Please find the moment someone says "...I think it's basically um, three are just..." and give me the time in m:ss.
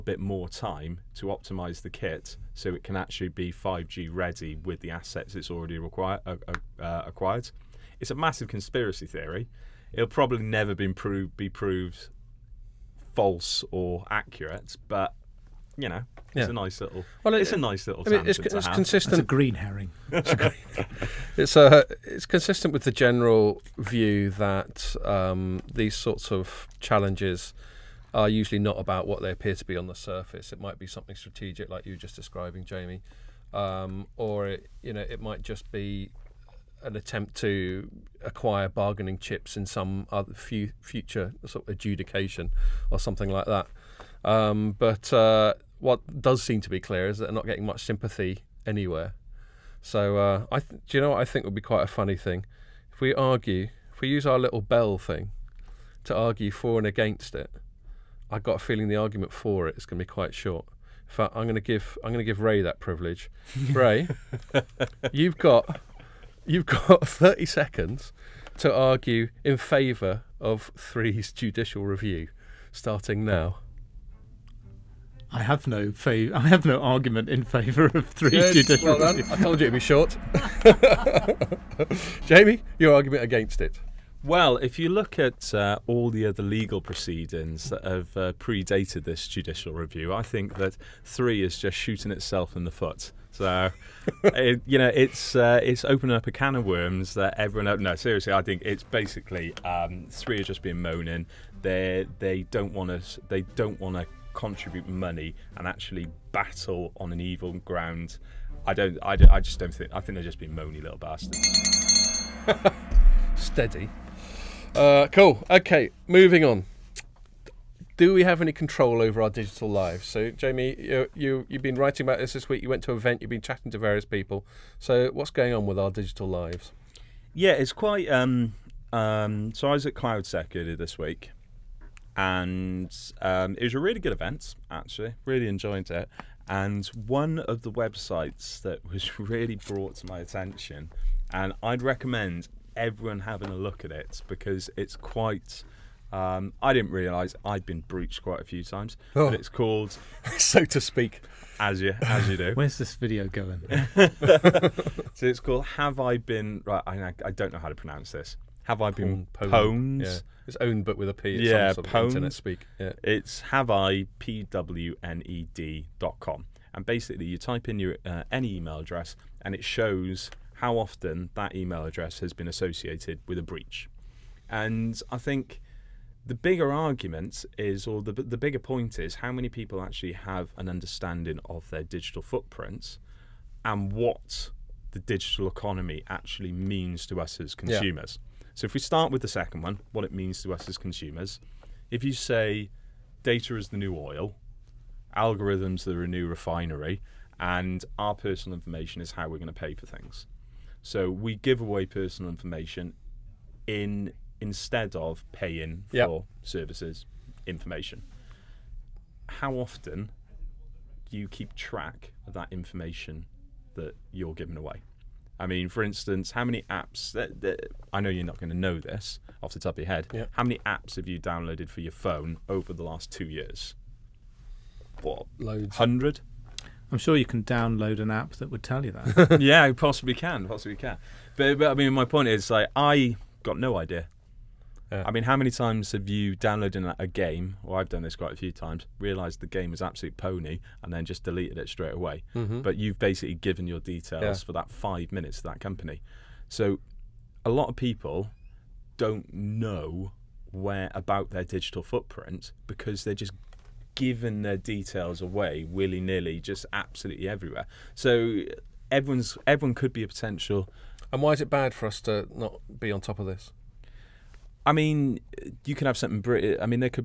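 1:38.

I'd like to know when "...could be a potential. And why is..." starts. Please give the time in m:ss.
4:19.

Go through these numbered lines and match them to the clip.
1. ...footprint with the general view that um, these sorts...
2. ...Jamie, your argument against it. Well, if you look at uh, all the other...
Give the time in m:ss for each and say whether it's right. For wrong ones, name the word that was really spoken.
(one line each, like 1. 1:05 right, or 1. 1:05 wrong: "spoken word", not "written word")
1. 0:22 wrong: "consistent", not "footprint"
2. 1:22 right.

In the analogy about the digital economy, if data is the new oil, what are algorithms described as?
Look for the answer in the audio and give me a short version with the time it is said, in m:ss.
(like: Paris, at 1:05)
a new refinery, at 3:16.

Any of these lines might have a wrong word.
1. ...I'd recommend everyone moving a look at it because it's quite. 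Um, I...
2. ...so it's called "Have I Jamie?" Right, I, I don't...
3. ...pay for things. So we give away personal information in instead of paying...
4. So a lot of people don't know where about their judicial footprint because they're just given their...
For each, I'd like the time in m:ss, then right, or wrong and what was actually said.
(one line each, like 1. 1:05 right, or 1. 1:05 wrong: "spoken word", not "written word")
1. 2:21 wrong: "having", not "moving"
2. 2:33 wrong: "Been", not "Jamie"
3. 3:19 right
4. 4:06 wrong: "digital", not "judicial".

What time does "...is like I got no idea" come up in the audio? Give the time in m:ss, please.
3:52.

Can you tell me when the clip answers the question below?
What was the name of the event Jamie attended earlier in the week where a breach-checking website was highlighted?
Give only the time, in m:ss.
2:09.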